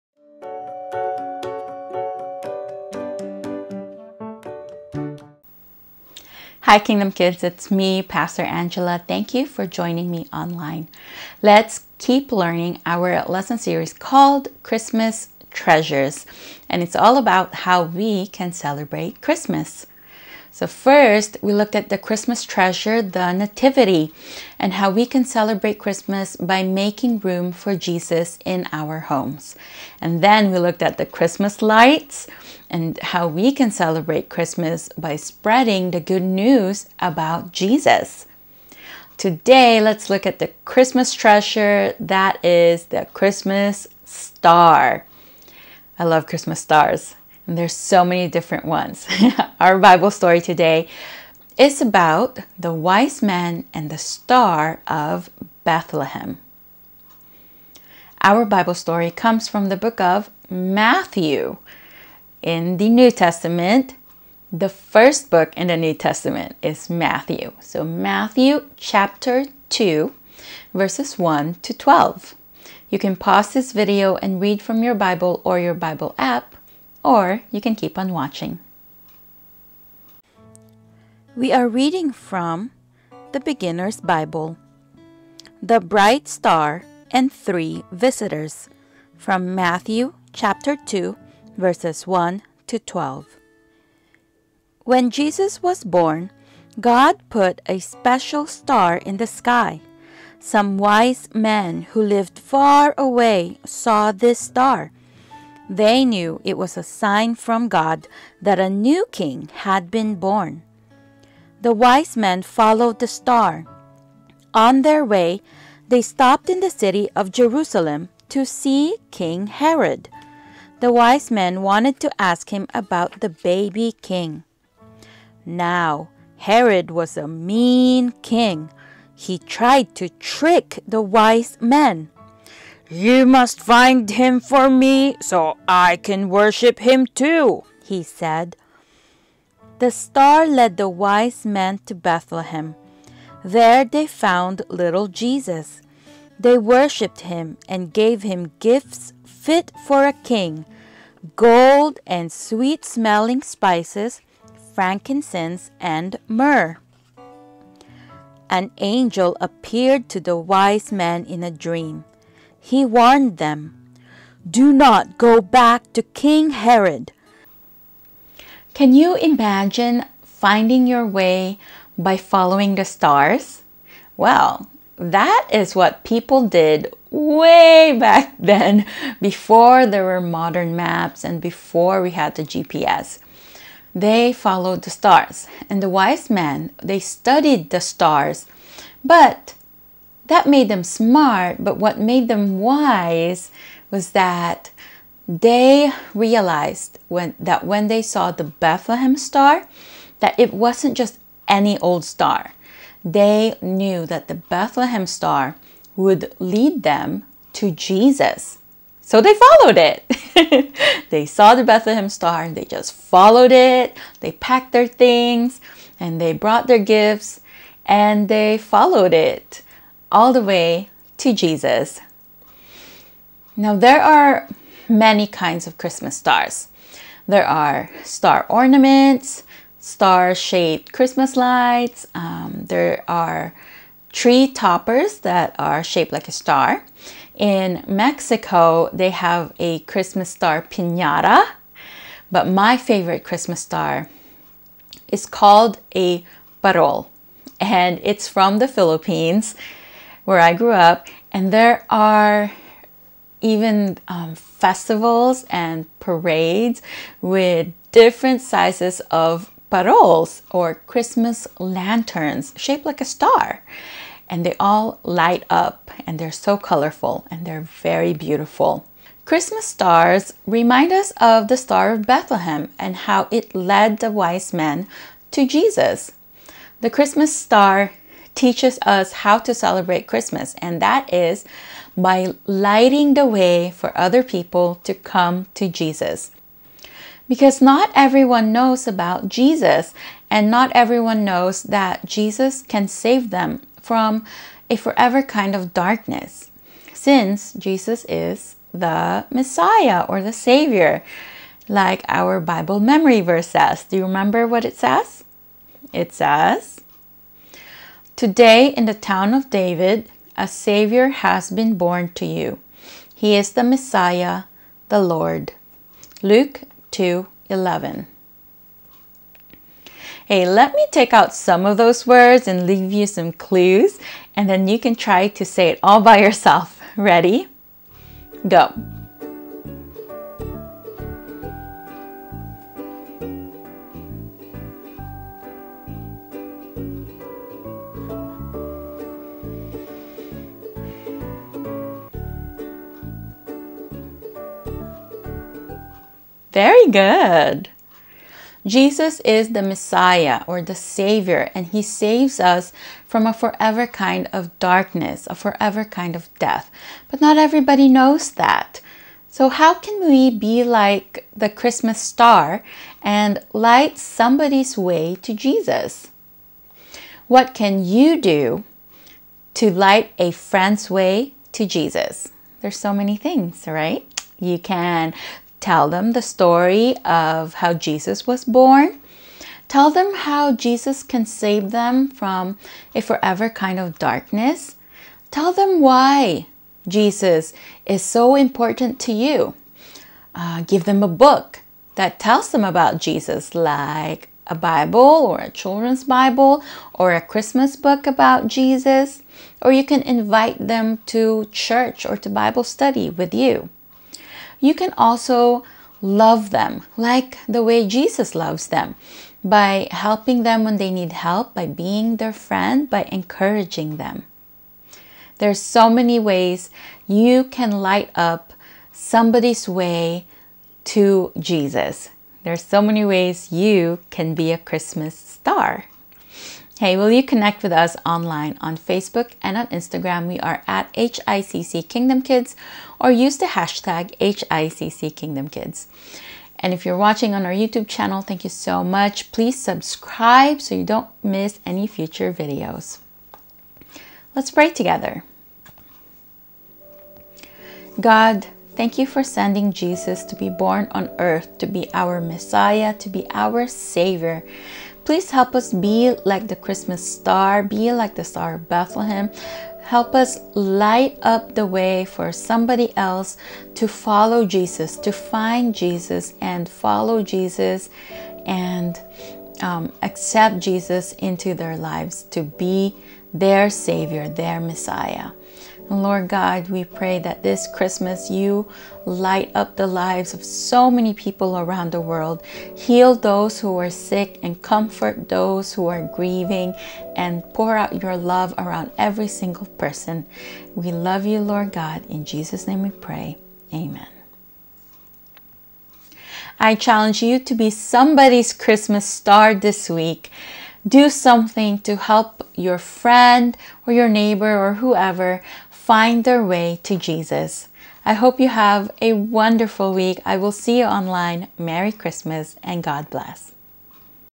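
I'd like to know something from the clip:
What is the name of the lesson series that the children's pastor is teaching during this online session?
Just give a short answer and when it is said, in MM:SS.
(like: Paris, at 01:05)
Christmas Treasures, at 00:14.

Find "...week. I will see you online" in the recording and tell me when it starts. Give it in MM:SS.
08:29.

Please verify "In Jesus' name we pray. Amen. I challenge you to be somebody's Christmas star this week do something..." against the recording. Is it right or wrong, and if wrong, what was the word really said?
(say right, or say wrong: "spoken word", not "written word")
right.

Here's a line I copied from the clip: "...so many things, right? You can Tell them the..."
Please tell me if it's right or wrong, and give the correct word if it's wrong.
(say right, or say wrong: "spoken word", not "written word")
right.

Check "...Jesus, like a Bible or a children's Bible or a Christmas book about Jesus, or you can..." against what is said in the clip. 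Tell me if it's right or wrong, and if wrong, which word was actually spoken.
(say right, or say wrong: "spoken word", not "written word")
right.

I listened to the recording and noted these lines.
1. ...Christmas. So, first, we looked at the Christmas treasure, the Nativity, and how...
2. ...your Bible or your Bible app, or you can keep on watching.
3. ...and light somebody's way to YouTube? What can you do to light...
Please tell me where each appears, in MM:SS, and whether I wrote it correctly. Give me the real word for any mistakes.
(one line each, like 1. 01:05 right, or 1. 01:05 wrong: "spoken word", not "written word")
1. 00:19 right
2. 01:14 right
3. 06:03 wrong: "Jesus", not "YouTube".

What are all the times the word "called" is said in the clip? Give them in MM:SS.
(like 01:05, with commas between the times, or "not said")
00:13, 04:05.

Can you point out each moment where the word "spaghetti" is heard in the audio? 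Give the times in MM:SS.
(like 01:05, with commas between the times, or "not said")
not said.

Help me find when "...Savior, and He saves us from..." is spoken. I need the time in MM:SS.
05:50.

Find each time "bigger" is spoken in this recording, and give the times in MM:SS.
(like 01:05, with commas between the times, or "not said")
not said.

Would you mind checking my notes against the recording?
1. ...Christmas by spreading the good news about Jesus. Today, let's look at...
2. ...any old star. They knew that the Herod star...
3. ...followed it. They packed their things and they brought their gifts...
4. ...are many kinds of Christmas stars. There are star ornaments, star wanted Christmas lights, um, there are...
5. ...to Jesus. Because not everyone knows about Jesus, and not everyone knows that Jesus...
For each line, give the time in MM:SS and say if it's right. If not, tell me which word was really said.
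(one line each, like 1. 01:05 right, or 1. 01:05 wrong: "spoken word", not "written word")
1. 00:34 right
2. 03:21 wrong: "Bethlehem", not "Herod"
3. 03:32 right
4. 03:44 wrong: "shaped", not "wanted"
5. 04:45 right.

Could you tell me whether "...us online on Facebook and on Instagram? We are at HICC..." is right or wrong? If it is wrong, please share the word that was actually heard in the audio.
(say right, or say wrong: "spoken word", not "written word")
right.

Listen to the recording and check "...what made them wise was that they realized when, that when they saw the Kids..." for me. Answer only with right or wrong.
wrong.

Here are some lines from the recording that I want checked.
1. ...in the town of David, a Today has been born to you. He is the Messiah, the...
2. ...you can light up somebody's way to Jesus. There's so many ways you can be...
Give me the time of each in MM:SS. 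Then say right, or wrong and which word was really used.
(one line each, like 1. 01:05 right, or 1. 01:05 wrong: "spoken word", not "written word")
1. 05:08 wrong: "Savior", not "Today"
2. 06:57 right.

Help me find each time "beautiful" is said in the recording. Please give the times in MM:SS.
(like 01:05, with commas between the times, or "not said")
04:28.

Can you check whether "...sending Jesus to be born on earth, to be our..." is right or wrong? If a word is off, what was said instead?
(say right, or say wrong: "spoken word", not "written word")
right.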